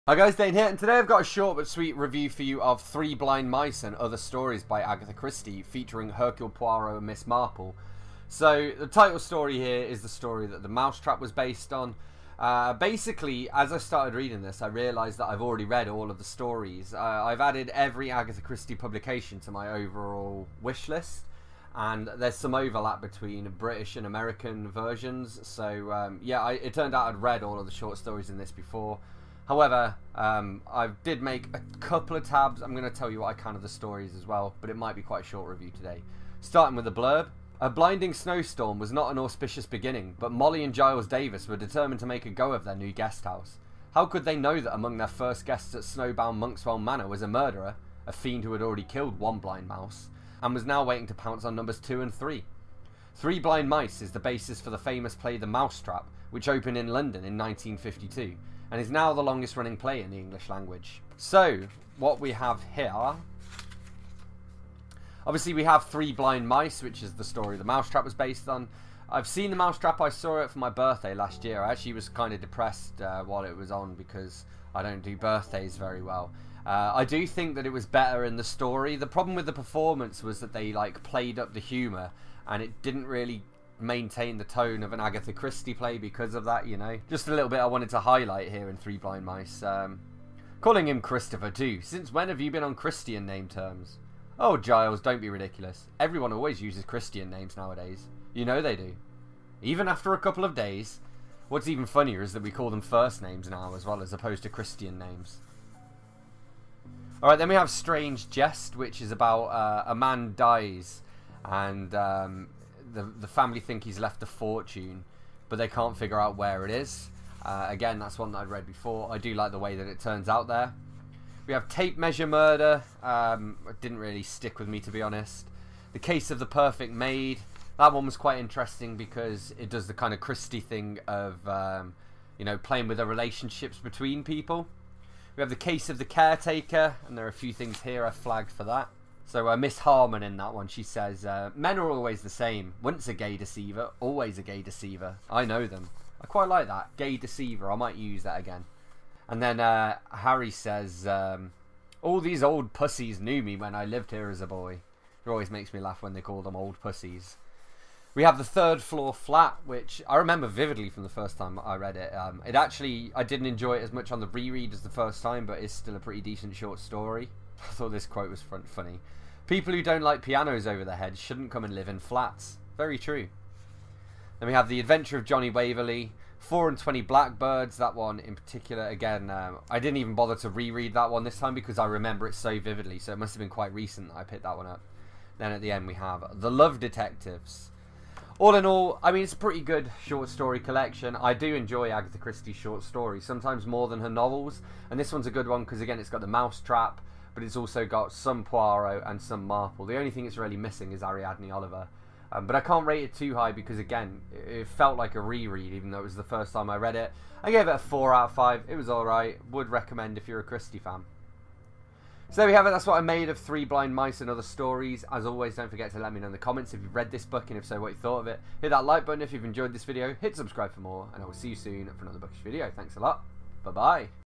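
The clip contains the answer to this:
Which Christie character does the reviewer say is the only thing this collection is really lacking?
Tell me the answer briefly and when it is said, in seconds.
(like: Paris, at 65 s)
Ariadne Oliver, at 201 s.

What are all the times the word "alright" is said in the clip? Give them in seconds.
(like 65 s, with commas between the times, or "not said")
107 s, 208 s.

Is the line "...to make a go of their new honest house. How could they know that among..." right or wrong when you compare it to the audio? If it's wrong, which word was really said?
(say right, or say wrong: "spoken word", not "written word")
wrong: "guest", not "honest".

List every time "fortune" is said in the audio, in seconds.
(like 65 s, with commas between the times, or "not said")
114 s.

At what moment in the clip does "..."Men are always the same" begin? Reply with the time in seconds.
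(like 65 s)
141 s.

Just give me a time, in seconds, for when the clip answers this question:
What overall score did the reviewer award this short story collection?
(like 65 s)
207 s.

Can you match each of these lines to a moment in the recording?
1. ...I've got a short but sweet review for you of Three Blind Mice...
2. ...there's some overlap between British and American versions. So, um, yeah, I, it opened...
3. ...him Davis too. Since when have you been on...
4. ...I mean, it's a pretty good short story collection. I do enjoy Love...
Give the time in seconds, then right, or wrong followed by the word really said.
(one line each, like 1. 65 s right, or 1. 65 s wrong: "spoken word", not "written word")
1. 0 s right
2. 22 s wrong: "turned", not "opened"
3. 90 s wrong: "Christopher", not "Davis"
4. 189 s wrong: "Agatha", not "Love".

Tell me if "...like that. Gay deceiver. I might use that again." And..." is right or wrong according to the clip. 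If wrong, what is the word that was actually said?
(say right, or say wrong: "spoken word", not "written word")
right.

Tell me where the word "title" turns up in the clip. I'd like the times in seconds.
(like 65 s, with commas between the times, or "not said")
8 s.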